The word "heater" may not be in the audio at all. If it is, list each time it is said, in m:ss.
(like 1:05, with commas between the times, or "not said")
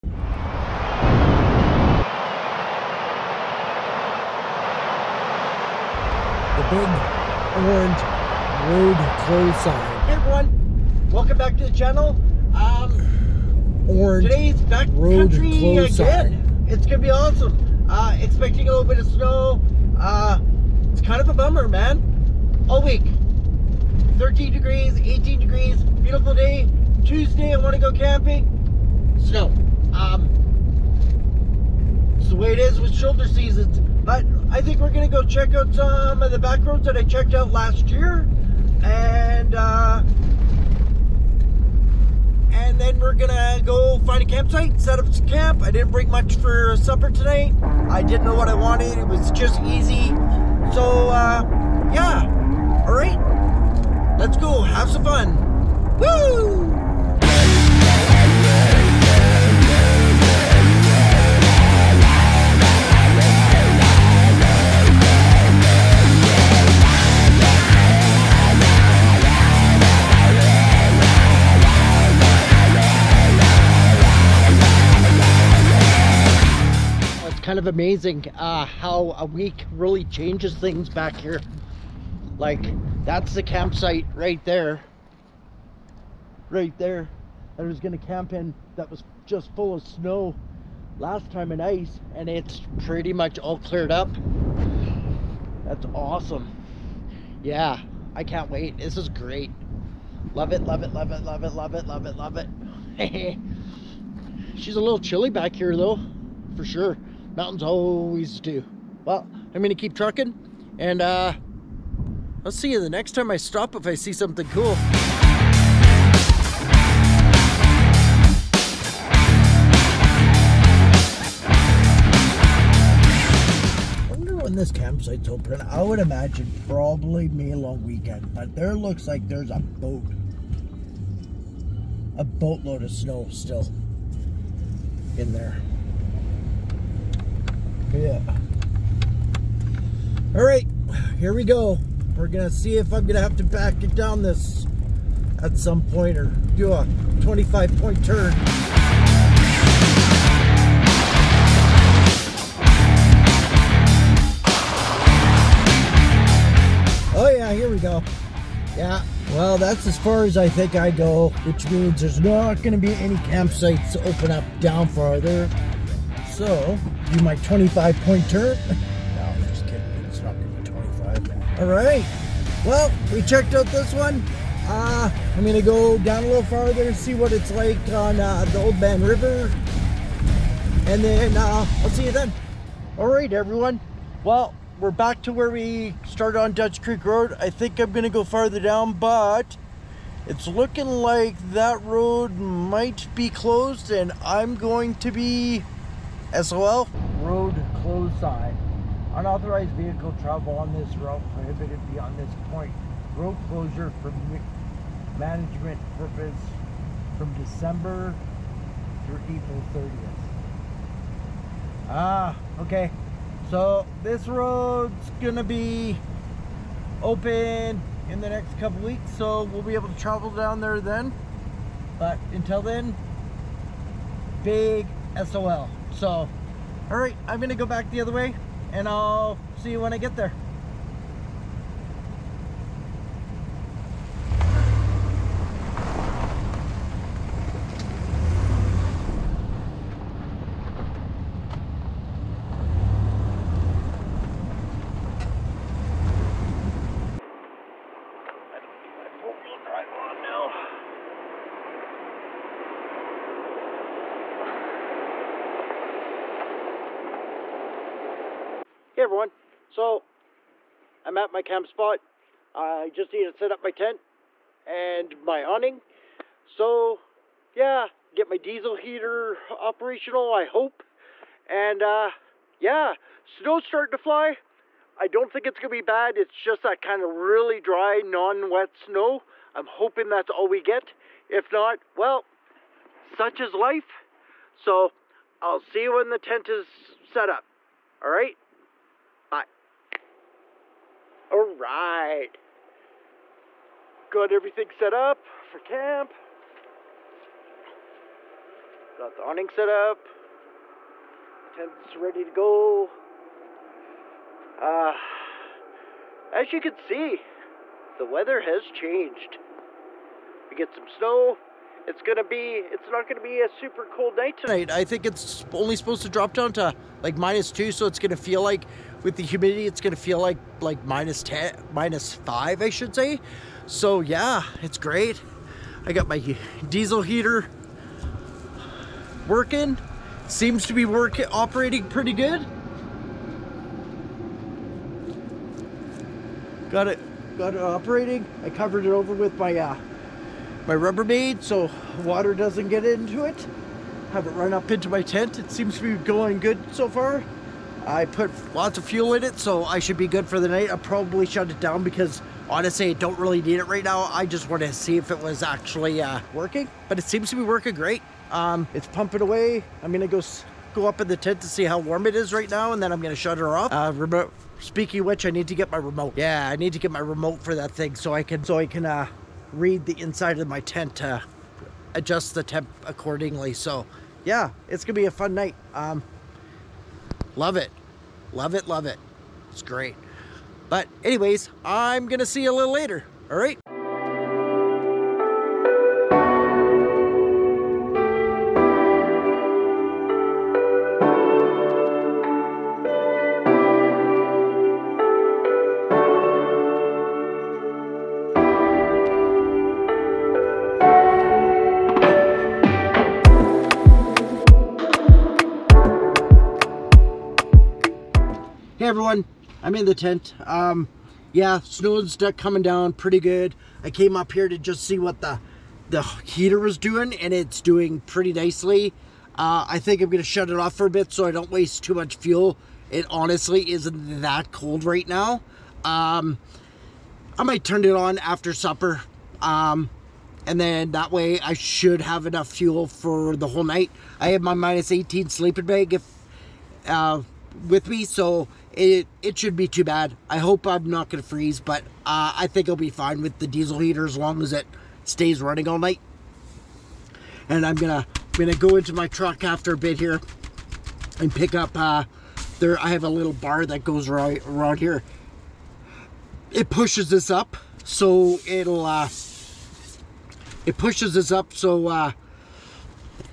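4:28, 5:27, 6:56, 7:23.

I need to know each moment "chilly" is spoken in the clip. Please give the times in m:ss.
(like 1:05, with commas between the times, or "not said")
1:44.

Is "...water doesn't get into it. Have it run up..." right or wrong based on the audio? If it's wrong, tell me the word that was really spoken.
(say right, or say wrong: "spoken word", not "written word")
right.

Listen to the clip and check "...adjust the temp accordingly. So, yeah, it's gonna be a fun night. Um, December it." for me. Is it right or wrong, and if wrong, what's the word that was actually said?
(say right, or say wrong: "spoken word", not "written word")
wrong: "Love", not "December".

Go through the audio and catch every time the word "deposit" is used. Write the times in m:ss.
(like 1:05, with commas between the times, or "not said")
not said.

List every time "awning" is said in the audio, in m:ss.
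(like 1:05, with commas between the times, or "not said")
4:25, 4:59.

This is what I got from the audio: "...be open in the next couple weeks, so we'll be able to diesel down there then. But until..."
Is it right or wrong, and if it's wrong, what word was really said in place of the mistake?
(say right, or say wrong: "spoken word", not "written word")
wrong: "travel", not "diesel".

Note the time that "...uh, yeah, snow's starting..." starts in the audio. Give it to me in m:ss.
4:31.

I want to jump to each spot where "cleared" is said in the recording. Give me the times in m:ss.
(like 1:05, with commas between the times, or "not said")
1:33.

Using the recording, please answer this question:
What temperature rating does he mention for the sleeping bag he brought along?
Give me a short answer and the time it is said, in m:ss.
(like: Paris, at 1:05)
Minus 18, at 7:14.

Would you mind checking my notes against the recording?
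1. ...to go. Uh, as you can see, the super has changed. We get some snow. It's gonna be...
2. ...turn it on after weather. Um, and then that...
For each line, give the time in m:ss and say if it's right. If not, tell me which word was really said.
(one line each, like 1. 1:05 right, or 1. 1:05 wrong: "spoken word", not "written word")
1. 5:02 wrong: "weather", not "super"
2. 7:07 wrong: "supper", not "weather".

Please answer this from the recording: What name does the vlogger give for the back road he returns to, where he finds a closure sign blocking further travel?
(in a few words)
Dutch Creek Road.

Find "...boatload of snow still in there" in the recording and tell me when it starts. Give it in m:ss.
2:12.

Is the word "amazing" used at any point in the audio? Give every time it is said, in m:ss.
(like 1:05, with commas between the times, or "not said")
1:17.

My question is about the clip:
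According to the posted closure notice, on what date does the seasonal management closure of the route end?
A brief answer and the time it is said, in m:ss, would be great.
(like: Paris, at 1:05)
April 30th, at 3:29.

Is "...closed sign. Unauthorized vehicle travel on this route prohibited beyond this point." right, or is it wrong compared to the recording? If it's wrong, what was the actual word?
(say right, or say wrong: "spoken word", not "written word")
right.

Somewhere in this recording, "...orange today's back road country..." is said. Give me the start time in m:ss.
0:13.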